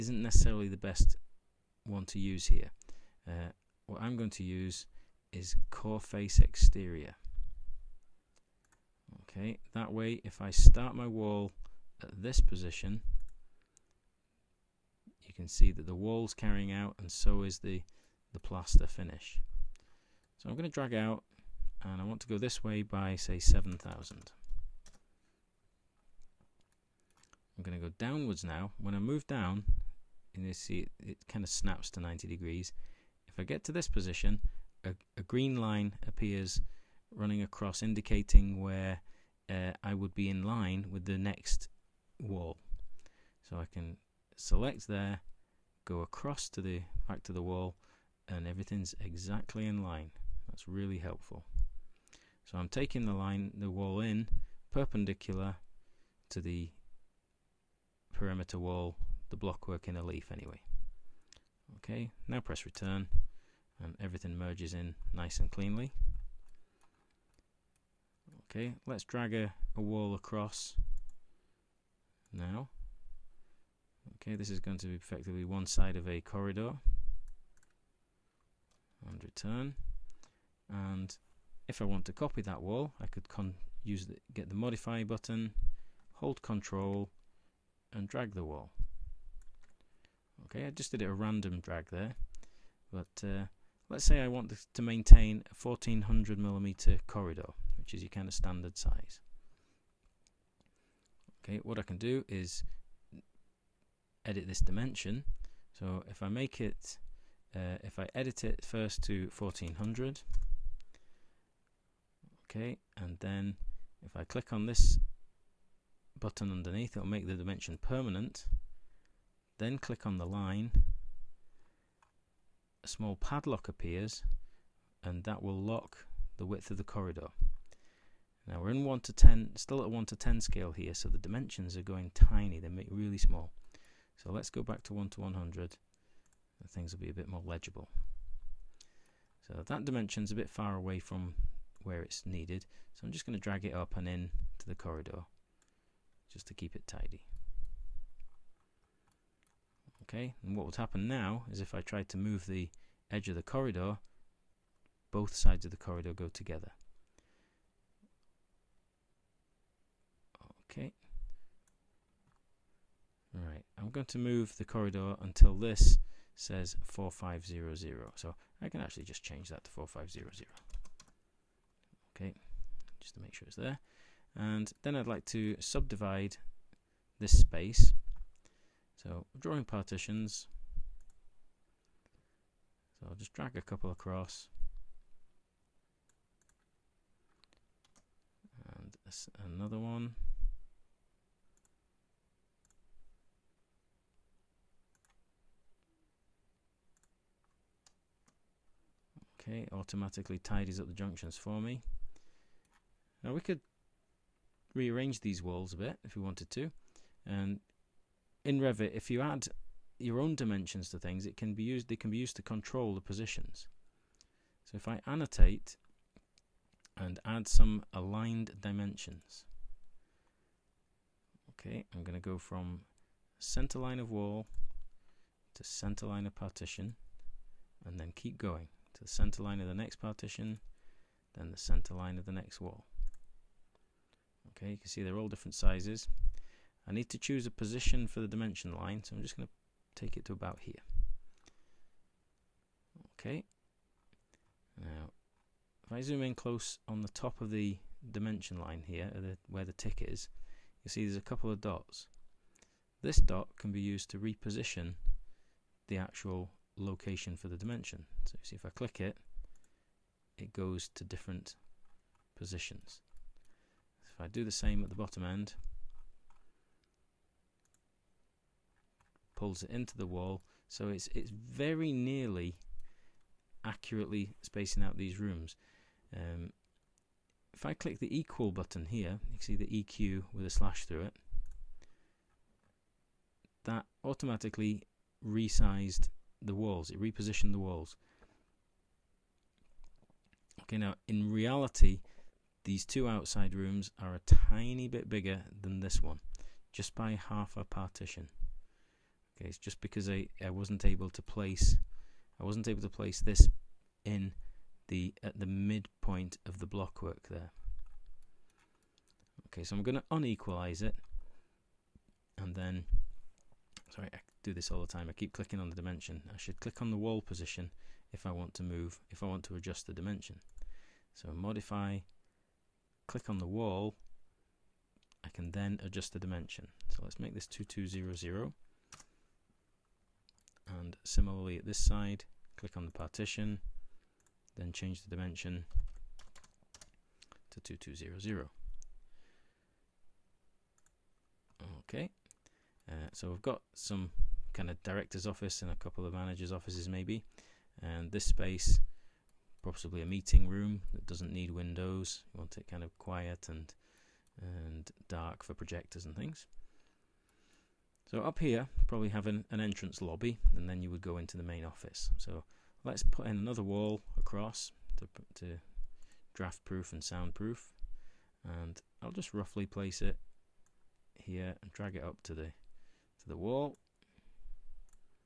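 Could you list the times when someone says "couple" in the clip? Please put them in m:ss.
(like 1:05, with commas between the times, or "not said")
3:03, 4:11, 5:45.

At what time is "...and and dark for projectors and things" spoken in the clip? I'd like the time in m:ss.
5:53.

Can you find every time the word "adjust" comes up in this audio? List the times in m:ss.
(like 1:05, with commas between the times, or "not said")
5:19, 5:25.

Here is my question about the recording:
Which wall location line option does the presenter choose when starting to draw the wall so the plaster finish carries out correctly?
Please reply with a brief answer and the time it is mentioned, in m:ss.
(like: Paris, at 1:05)
core face exterior, at 0:05.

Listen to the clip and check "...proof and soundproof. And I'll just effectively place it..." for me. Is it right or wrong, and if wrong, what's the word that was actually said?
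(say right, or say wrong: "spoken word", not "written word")
wrong: "roughly", not "effectively".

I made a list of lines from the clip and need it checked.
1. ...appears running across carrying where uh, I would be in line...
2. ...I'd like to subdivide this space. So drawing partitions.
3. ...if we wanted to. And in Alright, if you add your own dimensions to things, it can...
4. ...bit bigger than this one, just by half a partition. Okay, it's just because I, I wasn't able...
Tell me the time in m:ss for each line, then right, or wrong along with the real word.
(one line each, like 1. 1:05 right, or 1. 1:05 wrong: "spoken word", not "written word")
1. 0:36 wrong: "indicating", not "carrying"
2. 2:54 right
3. 3:26 wrong: "Revit", not "Alright"
4. 4:54 right.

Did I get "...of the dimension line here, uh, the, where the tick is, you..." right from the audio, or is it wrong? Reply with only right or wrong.
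right.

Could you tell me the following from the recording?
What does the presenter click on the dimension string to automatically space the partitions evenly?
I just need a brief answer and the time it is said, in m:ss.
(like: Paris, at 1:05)
the equal button, at 4:38.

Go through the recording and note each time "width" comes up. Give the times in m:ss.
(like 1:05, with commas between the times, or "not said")
2:06.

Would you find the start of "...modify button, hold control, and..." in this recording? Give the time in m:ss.
1:24.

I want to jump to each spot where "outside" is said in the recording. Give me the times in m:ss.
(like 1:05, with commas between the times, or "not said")
4:53.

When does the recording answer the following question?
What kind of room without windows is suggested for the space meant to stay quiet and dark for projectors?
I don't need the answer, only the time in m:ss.
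5:50.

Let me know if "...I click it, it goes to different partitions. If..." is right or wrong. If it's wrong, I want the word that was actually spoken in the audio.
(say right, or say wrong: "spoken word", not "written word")
wrong: "positions", not "partitions".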